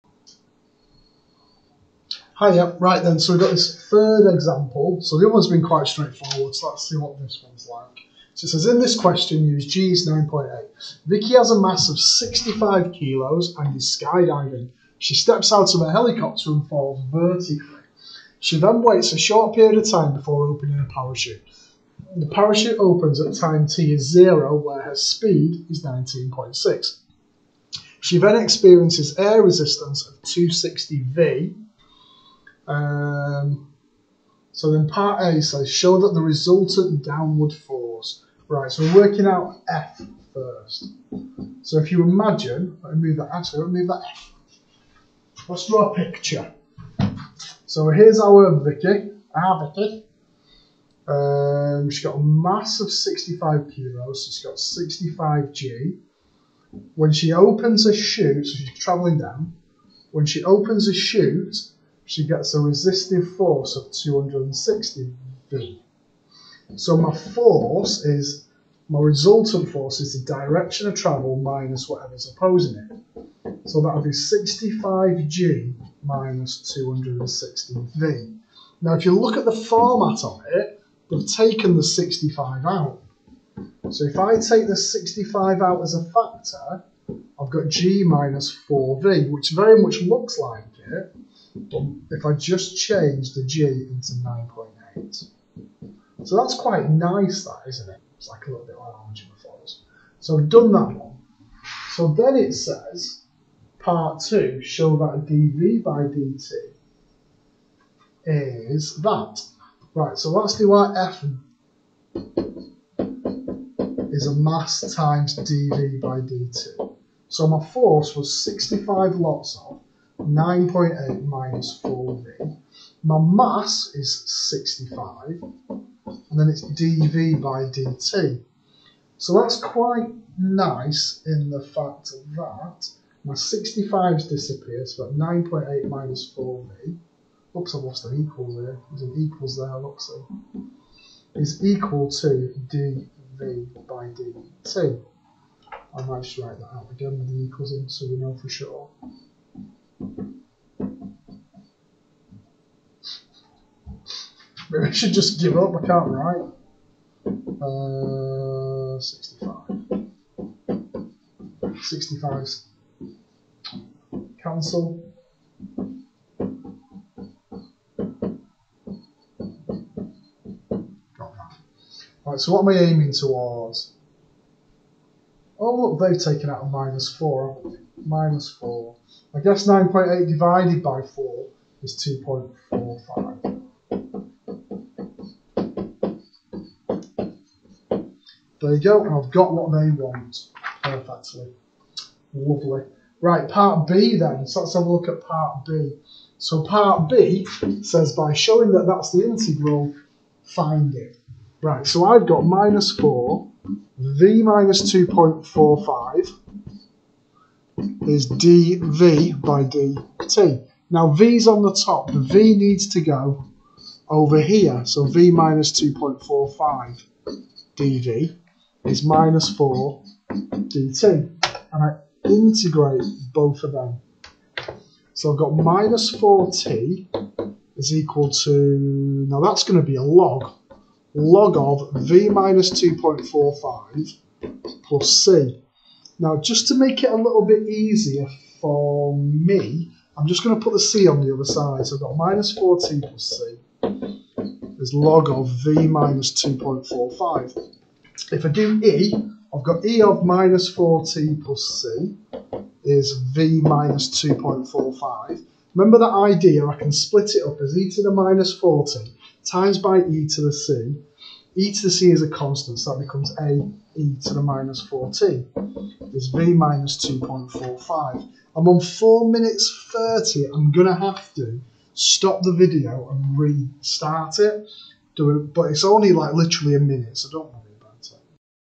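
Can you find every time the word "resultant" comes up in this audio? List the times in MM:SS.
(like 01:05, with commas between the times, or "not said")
00:36, 01:08.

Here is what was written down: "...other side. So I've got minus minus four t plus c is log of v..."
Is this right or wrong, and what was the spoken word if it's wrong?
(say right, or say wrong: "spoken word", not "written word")
right.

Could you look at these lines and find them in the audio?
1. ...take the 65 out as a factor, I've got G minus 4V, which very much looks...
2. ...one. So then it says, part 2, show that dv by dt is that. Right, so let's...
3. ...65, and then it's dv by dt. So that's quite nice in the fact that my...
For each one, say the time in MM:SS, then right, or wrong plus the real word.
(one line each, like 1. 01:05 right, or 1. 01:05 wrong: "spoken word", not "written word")
1. 01:24 right
2. 01:40 right
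3. 02:04 right.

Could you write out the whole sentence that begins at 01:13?
So that would be 65G minus 260V.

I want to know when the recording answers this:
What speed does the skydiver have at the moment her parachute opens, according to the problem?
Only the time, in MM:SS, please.
00:25.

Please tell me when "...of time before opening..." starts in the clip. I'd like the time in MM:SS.
00:19.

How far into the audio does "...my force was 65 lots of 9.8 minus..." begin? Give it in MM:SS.
01:57.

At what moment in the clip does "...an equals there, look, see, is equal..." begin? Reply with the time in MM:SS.
02:19.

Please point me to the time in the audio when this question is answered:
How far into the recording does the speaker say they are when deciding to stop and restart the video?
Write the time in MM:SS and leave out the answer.
04:28.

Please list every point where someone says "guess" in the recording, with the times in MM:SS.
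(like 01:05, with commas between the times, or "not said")
02:59.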